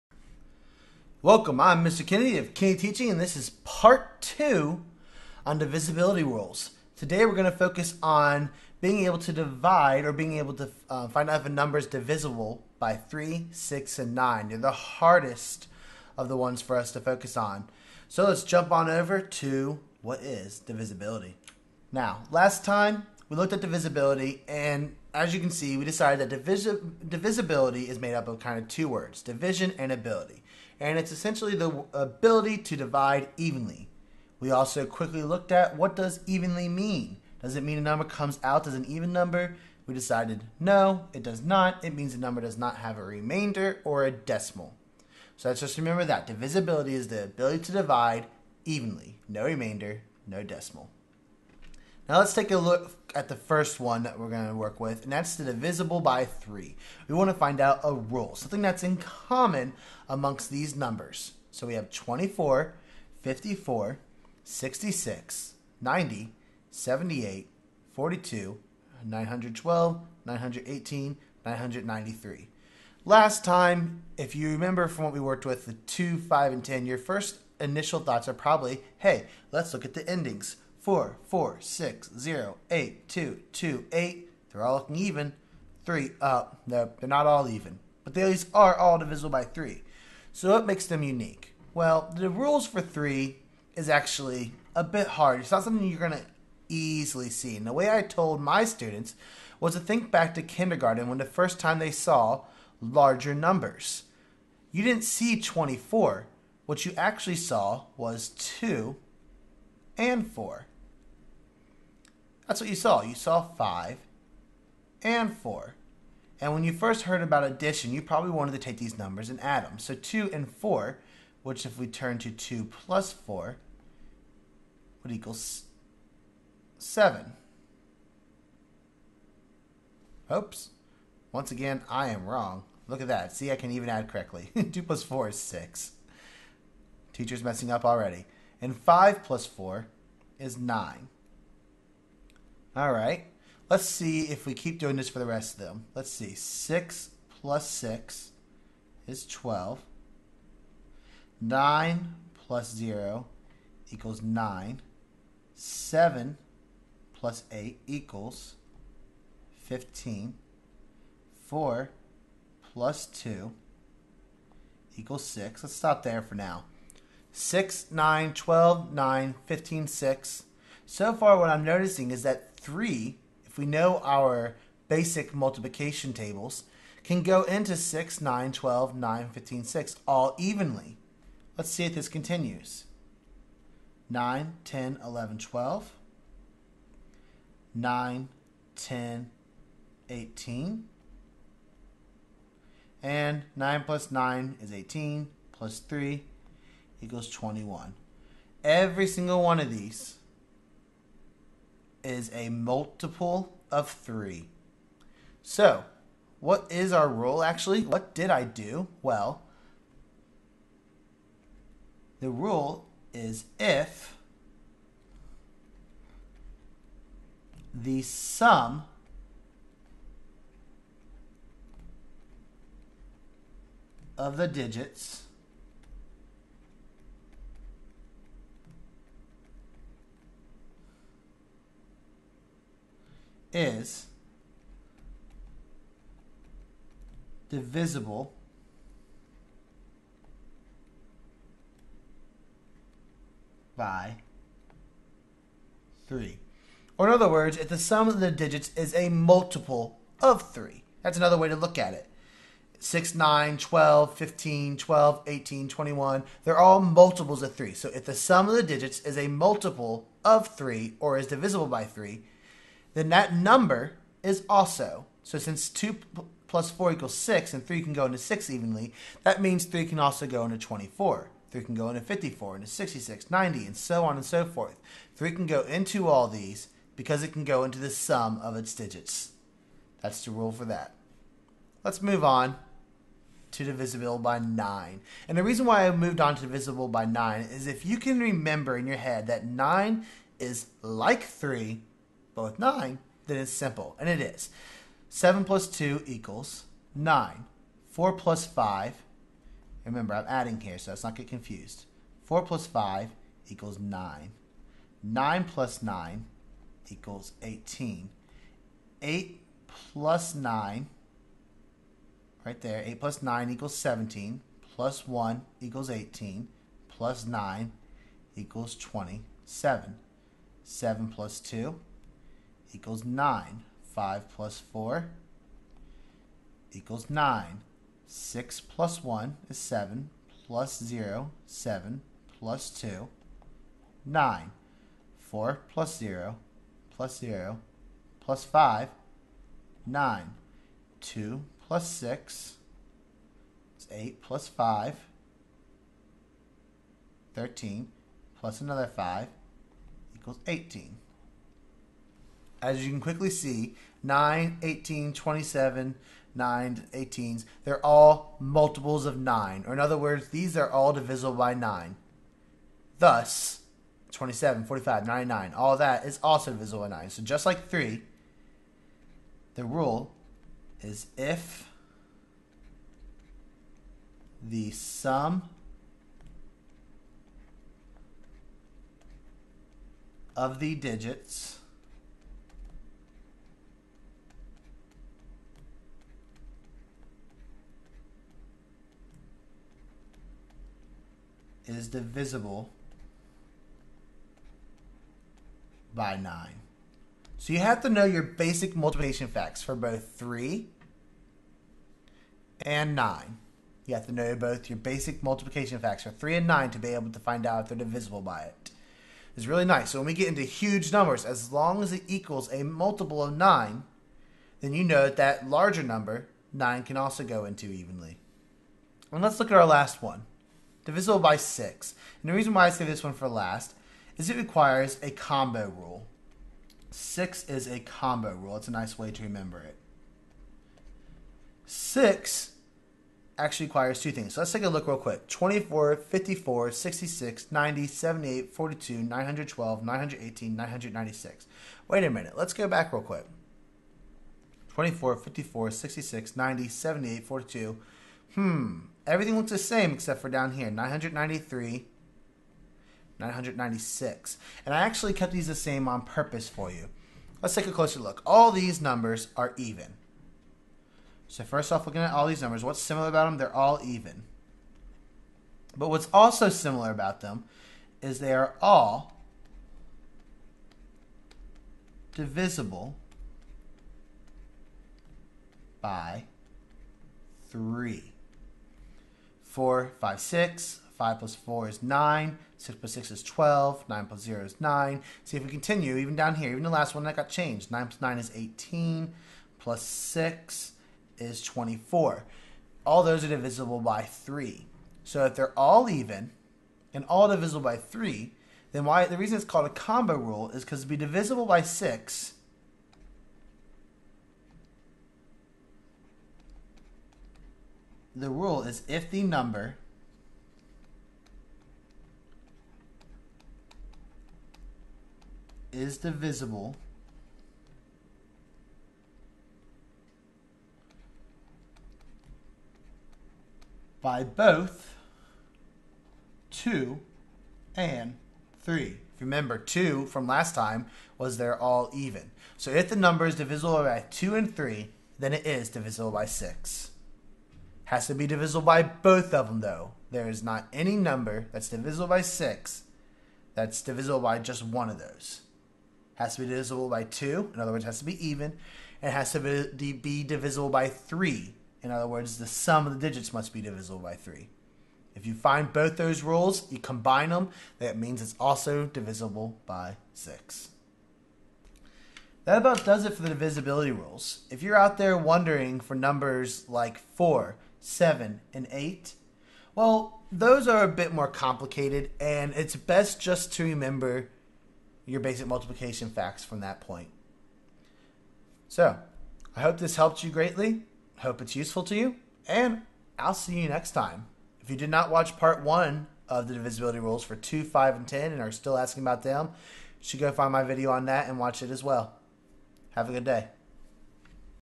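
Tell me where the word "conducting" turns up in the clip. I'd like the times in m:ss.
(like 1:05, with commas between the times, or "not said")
not said.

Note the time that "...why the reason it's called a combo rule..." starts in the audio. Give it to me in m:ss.
8:18.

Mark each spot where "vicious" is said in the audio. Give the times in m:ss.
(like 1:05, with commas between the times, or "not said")
not said.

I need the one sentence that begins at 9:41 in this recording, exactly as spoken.
Hope it's useful to you, and I'll see you next time.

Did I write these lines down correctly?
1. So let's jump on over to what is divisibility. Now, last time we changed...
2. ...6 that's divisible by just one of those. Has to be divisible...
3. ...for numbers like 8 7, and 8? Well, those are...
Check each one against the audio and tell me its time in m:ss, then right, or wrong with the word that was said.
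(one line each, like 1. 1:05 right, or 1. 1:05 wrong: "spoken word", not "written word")
1. 0:18 wrong: "looked", not "changed"
2. 9:02 right
3. 9:25 wrong: "4", not "8".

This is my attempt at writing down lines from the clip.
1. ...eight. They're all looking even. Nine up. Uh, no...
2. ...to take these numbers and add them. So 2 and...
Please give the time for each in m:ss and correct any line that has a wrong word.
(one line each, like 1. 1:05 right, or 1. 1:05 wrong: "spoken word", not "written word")
1. 1:23 wrong: "Three", not "Nine"
2. 1:58 right.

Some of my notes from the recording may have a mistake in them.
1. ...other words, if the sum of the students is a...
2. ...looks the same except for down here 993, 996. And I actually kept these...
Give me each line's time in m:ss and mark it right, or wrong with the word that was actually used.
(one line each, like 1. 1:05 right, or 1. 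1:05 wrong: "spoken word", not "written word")
1. 4:07 wrong: "digits", not "students"
2. 7:29 right.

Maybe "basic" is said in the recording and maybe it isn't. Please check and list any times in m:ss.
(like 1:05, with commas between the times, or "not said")
2:54, 6:38, 6:44, 9:35.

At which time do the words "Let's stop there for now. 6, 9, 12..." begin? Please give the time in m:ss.
2:45.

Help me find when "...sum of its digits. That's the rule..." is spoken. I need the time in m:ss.
4:37.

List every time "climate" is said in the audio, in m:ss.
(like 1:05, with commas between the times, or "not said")
not said.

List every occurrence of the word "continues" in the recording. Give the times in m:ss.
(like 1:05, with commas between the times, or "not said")
3:02, 8:05.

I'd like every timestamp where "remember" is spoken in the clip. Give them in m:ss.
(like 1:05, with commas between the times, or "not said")
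0:45, 1:14, 4:48, 4:59, 7:09, 8:49, 9:33.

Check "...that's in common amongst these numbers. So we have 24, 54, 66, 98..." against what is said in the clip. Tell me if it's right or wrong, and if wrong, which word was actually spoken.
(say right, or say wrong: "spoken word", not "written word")
wrong: "90", not "98".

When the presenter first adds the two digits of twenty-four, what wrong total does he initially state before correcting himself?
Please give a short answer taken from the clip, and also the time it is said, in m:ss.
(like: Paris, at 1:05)
7, at 2:05.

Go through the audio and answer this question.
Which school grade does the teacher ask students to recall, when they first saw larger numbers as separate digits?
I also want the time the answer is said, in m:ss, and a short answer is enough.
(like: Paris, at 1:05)
kindergarten, at 1:40.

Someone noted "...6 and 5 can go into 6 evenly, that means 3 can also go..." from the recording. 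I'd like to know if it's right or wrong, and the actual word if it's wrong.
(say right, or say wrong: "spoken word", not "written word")
wrong: "3", not "5".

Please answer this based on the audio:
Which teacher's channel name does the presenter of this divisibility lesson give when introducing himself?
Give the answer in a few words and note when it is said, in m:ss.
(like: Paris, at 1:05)
Kennedy Teaching, at 0:02.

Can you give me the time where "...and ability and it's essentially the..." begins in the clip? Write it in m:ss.
0:29.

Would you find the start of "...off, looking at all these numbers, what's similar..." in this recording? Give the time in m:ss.
7:41.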